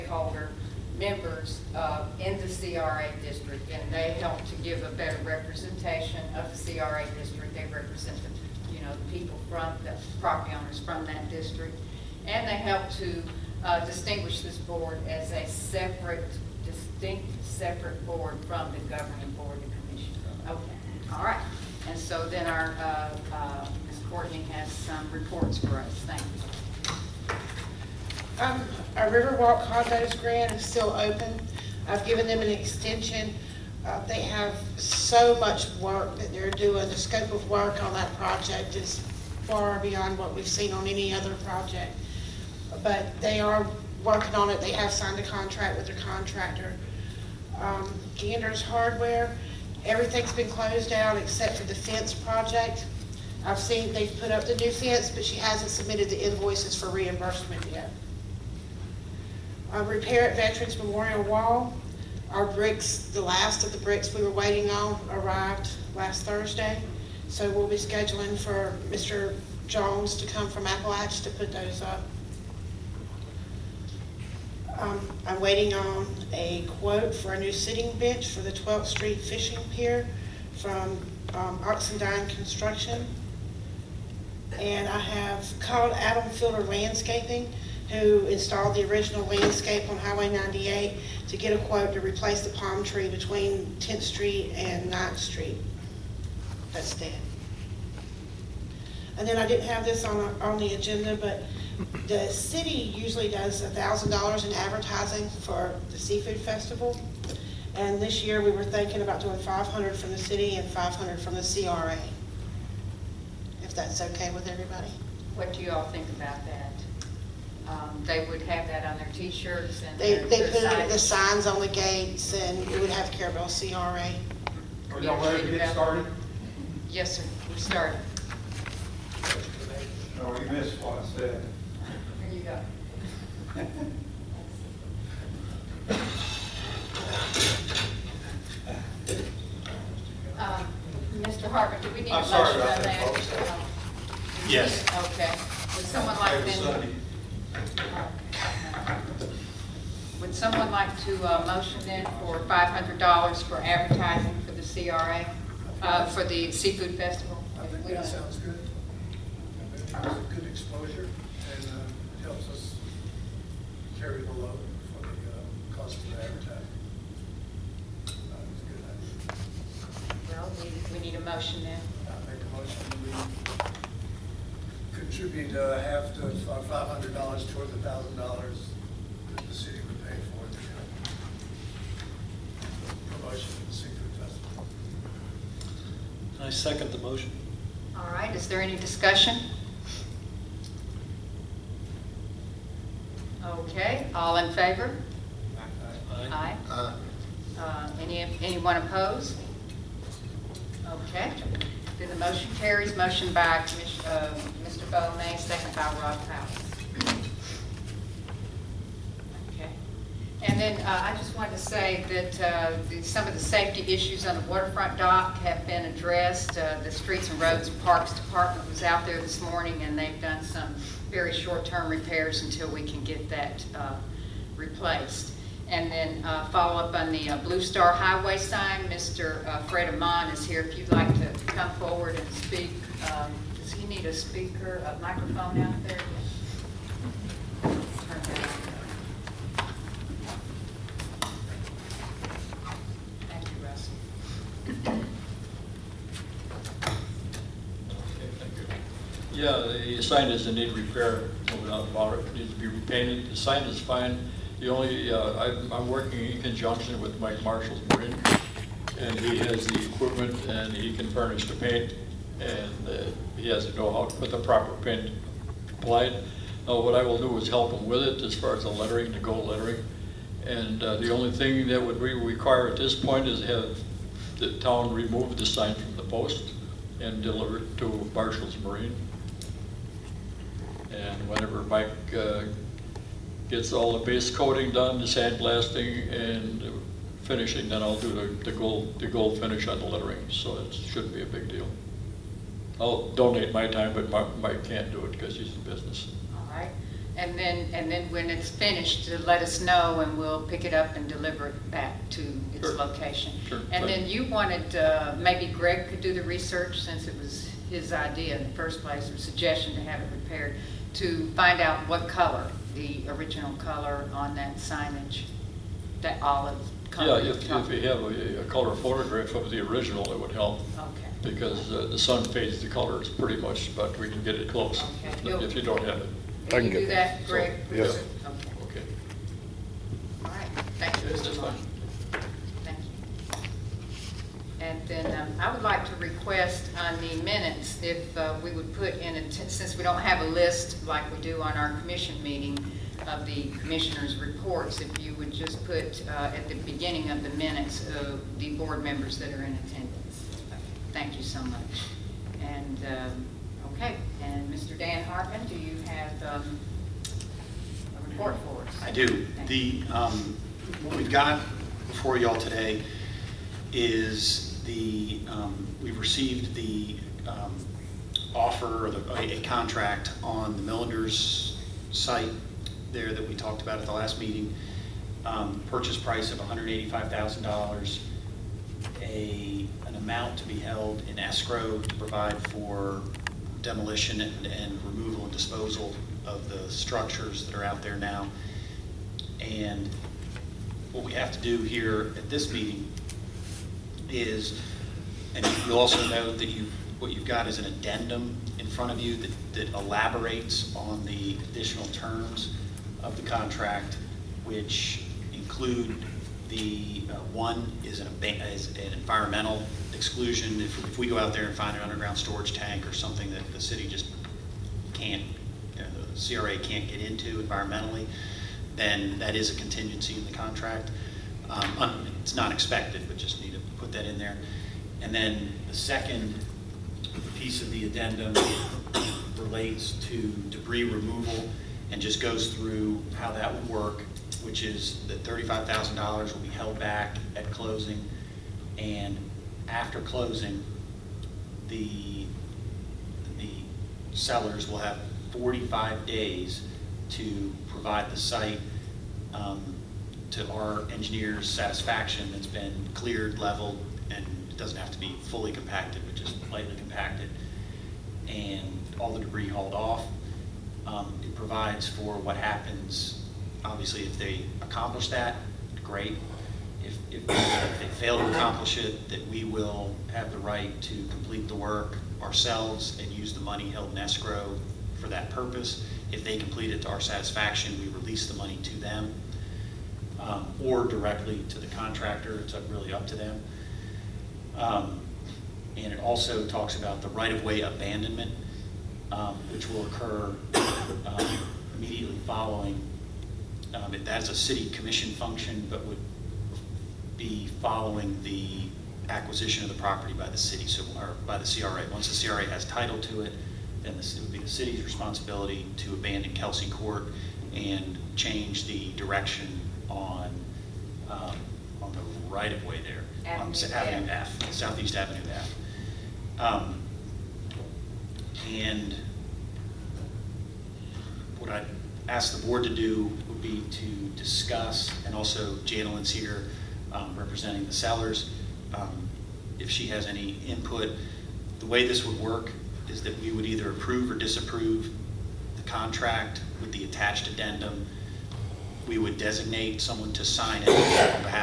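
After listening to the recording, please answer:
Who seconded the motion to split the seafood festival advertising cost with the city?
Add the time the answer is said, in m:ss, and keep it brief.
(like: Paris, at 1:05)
Rob Powell, at 3:26.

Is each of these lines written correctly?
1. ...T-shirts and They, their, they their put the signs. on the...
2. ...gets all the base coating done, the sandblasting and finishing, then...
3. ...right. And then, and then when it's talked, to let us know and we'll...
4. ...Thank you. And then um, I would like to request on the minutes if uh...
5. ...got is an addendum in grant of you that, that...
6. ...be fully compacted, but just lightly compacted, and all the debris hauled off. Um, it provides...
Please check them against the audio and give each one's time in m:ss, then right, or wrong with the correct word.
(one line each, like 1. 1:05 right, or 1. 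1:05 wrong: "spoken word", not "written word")
1. 1:59 right
2. 4:43 right
3. 4:56 wrong: "finished", not "talked"
4. 5:32 right
5. 6:37 wrong: "front", not "grant"
6. 7:34 right.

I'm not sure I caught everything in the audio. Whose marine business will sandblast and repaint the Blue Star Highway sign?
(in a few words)
Mike Marshall.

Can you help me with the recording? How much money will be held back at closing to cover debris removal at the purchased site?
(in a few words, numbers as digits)
$35,000.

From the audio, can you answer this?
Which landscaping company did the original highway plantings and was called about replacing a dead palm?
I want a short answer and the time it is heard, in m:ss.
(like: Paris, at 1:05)
Adam Fielder Landscaping, at 1:25.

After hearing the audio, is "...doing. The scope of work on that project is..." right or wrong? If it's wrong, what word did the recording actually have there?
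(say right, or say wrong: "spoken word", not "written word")
right.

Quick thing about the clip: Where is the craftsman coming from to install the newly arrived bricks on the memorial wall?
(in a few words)
Apalach.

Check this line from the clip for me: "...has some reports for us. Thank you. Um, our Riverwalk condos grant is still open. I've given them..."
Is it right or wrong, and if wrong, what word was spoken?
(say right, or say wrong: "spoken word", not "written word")
right.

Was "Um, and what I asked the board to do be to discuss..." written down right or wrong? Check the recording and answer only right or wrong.
right.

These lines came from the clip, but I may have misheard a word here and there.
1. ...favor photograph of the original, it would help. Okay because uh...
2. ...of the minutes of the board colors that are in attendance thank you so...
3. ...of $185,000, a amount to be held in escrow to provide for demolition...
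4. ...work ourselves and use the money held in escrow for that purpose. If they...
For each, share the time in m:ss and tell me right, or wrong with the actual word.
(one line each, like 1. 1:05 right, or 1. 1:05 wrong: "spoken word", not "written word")
1. 5:18 wrong: "color", not "favor"
2. 5:47 wrong: "members", not "colors"
3. 6:16 right
4. 7:51 right.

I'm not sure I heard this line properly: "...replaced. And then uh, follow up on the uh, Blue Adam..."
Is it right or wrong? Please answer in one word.
wrong.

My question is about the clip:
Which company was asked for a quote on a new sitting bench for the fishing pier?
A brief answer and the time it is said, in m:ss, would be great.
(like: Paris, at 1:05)
Oxendine Construction, at 1:21.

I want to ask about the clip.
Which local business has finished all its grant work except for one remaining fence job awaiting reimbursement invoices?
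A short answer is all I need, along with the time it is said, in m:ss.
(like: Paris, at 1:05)
Gander's Hardware, at 0:48.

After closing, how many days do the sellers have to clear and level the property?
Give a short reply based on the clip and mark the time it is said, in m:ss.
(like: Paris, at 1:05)
45, at 7:25.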